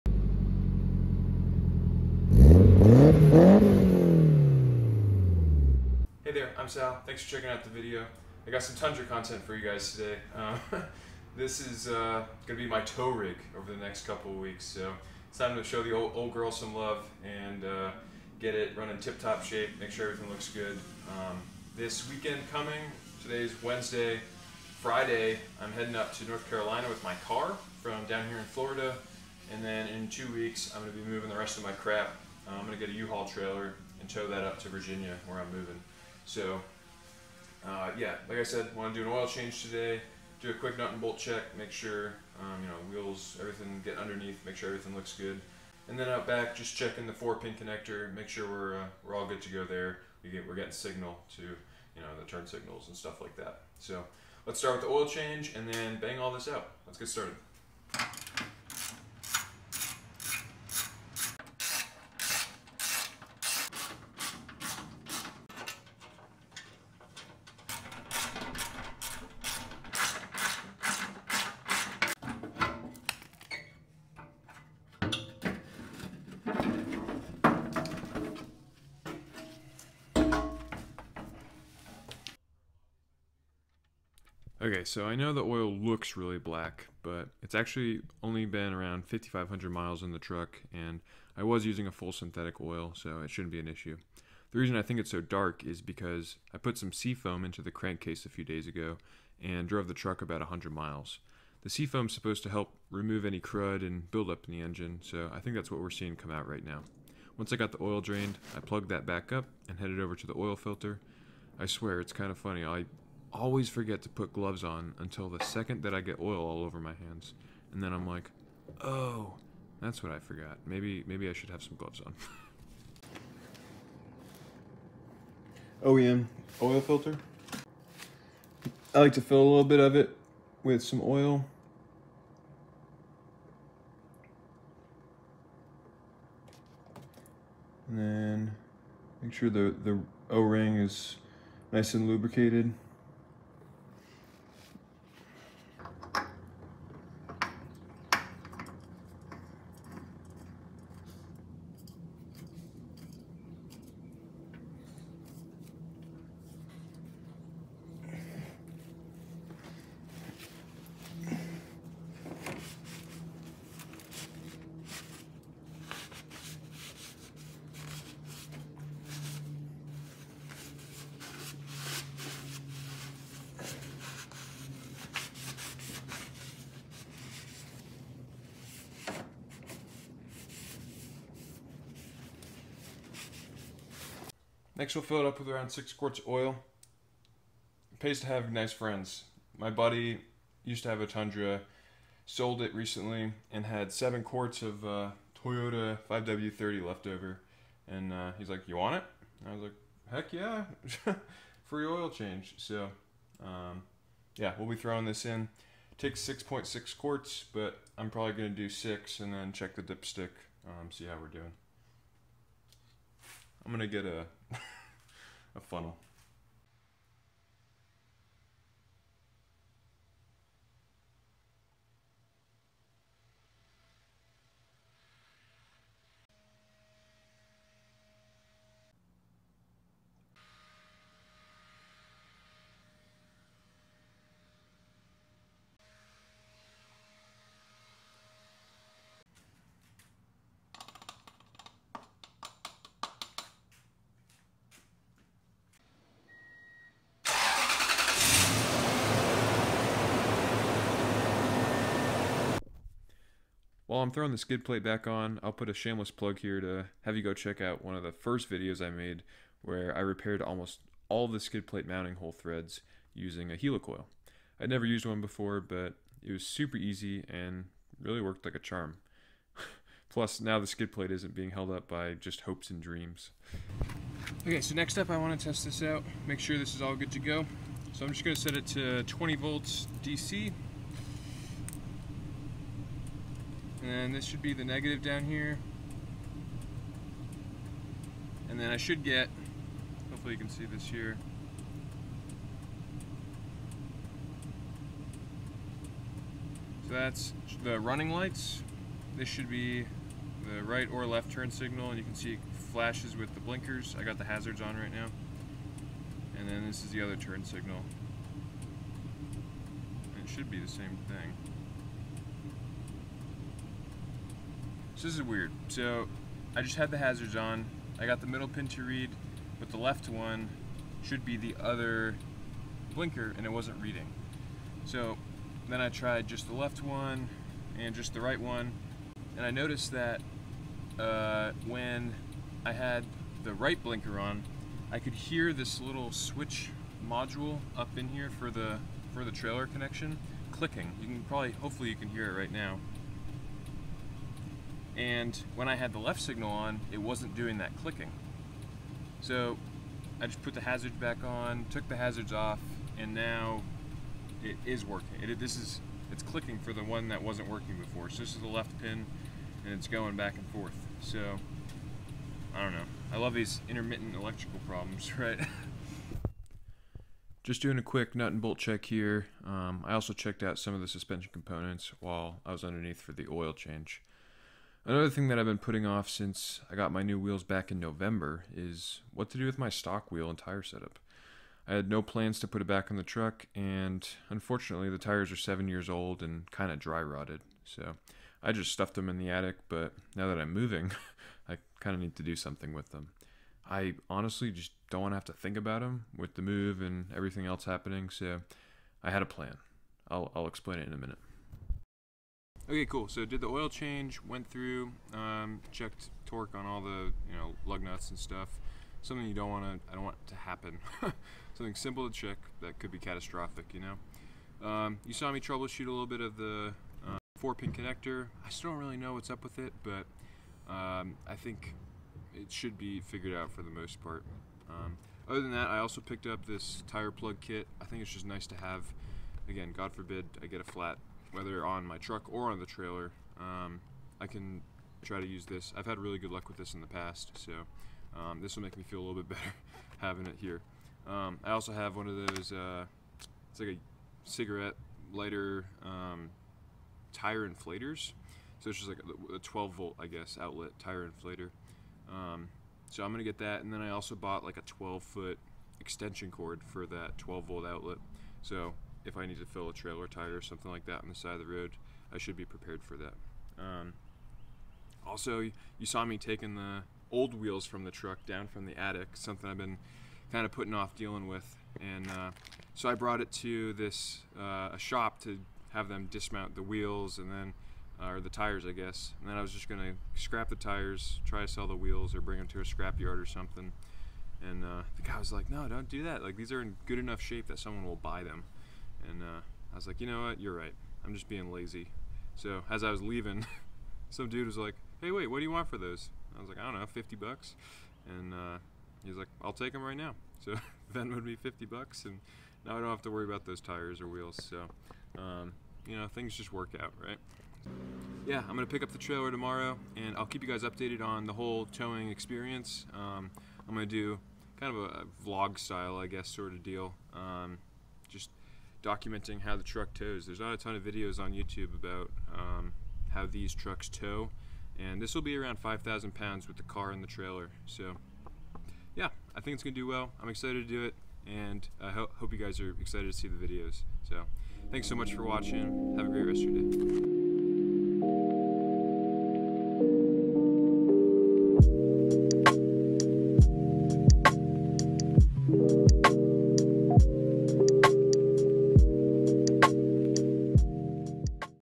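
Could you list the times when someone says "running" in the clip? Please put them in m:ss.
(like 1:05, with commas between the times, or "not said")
0:18, 4:57.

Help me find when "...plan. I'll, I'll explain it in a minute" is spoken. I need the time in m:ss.
6:39.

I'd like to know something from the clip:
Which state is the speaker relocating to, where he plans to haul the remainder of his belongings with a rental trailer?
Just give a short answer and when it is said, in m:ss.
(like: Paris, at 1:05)
Virginia, at 0:34.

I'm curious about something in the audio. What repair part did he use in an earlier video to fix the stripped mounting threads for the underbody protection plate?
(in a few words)
Helicoil.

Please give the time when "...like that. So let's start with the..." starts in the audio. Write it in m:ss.
0:53.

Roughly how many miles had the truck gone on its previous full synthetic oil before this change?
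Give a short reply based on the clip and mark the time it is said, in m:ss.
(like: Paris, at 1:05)
5,500, at 1:29.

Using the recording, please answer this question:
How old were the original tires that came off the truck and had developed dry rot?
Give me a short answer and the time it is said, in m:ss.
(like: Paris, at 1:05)
7 years, at 6:25.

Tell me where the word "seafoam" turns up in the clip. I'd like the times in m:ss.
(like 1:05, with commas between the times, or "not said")
1:36, 1:41.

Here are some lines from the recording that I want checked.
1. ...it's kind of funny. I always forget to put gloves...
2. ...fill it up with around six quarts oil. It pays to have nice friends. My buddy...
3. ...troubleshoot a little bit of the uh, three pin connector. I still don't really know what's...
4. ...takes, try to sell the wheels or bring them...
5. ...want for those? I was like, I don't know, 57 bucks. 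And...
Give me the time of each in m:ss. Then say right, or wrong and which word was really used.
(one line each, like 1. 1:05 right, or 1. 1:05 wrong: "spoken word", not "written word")
1. 1:51 right
2. 3:05 right
3. 6:55 wrong: "four", not "three"
4. 8:00 wrong: "tires", not "takes"
5. 8:15 wrong: "50", not "57".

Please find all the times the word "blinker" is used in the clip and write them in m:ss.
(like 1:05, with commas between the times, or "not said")
5:03, 5:22, 5:33.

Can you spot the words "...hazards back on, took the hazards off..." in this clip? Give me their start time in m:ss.
5:50.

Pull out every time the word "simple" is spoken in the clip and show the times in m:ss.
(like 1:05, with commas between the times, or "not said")
6:51.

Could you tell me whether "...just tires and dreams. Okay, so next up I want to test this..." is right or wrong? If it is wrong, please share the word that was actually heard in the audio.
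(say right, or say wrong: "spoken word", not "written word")
wrong: "hopes", not "tires".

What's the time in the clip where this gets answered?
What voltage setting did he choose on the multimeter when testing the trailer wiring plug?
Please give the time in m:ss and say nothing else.
4:39.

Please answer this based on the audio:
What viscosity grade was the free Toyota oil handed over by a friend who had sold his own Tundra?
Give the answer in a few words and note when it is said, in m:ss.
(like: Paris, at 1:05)
5W30, at 3:16.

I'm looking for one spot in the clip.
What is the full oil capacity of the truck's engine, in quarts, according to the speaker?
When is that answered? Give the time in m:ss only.
3:26.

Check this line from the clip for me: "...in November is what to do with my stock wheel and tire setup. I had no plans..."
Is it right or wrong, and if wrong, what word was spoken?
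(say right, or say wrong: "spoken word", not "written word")
right.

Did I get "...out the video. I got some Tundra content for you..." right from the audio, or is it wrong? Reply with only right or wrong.
right.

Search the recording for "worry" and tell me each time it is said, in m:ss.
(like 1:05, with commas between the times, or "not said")
8:23.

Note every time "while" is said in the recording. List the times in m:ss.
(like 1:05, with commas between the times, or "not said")
4:13, 6:12.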